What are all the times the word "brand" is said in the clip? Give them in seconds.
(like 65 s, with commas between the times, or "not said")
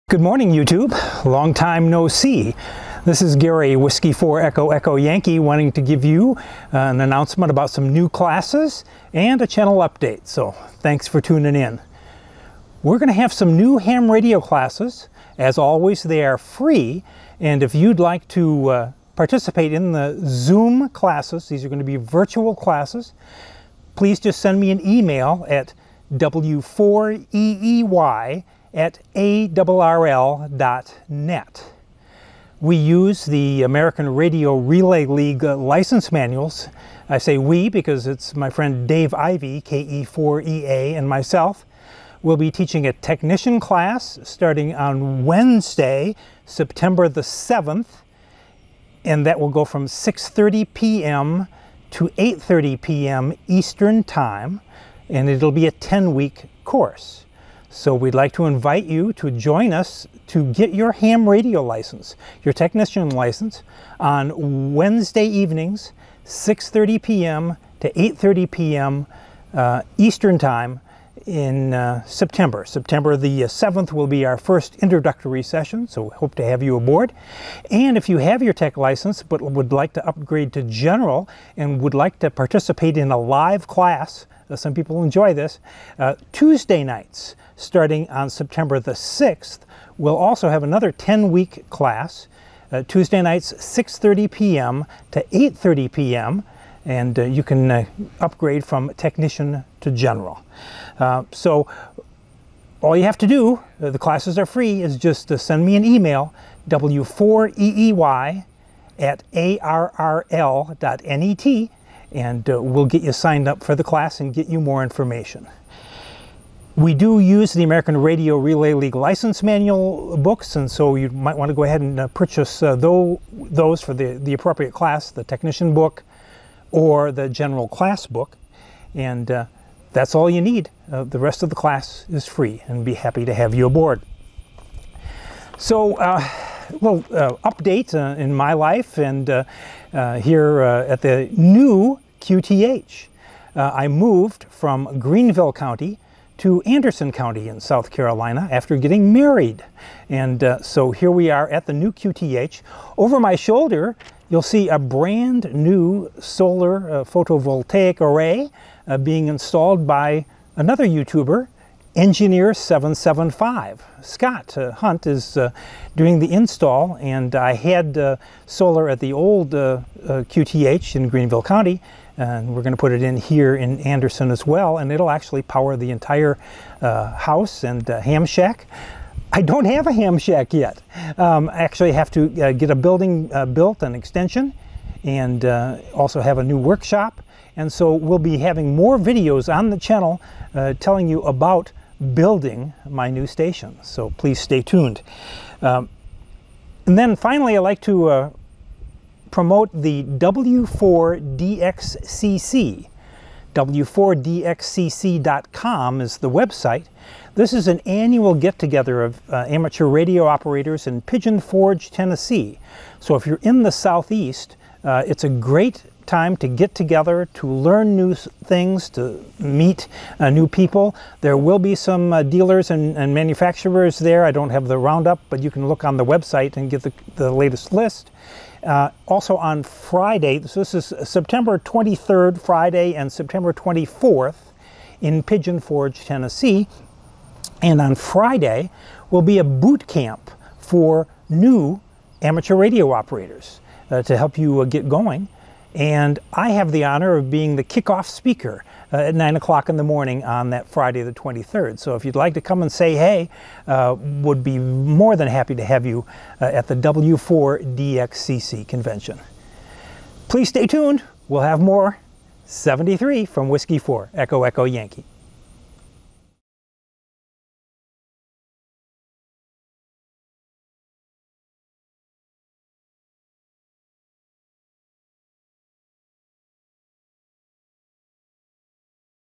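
154 s.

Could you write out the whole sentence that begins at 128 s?
And uh, that's all you need.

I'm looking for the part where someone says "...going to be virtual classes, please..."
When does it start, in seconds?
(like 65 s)
21 s.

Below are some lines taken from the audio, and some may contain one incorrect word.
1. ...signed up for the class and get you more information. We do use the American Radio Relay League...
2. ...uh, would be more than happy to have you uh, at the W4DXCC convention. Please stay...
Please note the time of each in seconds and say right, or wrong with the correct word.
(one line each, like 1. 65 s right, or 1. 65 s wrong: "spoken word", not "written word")
1. 113 s right
2. 253 s right.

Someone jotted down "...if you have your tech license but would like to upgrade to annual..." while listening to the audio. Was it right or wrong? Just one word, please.
wrong.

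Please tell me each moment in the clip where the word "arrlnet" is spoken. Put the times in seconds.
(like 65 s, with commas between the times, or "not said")
29 s, 109 s.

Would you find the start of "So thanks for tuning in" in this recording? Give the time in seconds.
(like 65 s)
10 s.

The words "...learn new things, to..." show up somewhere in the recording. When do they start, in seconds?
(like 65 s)
217 s.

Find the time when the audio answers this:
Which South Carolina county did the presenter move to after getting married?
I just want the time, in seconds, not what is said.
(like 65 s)
146 s.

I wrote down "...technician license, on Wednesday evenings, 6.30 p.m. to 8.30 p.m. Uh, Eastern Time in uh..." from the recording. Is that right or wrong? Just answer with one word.
right.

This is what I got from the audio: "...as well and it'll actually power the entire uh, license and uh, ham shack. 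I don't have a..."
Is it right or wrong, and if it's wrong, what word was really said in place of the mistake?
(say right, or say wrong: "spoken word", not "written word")
wrong: "house", not "license".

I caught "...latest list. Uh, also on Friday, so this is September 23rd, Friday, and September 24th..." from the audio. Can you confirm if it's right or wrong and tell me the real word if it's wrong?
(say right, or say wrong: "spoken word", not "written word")
right.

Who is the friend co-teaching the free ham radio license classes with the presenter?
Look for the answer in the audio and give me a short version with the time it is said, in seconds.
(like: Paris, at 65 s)
Dave Ivy, at 38 s.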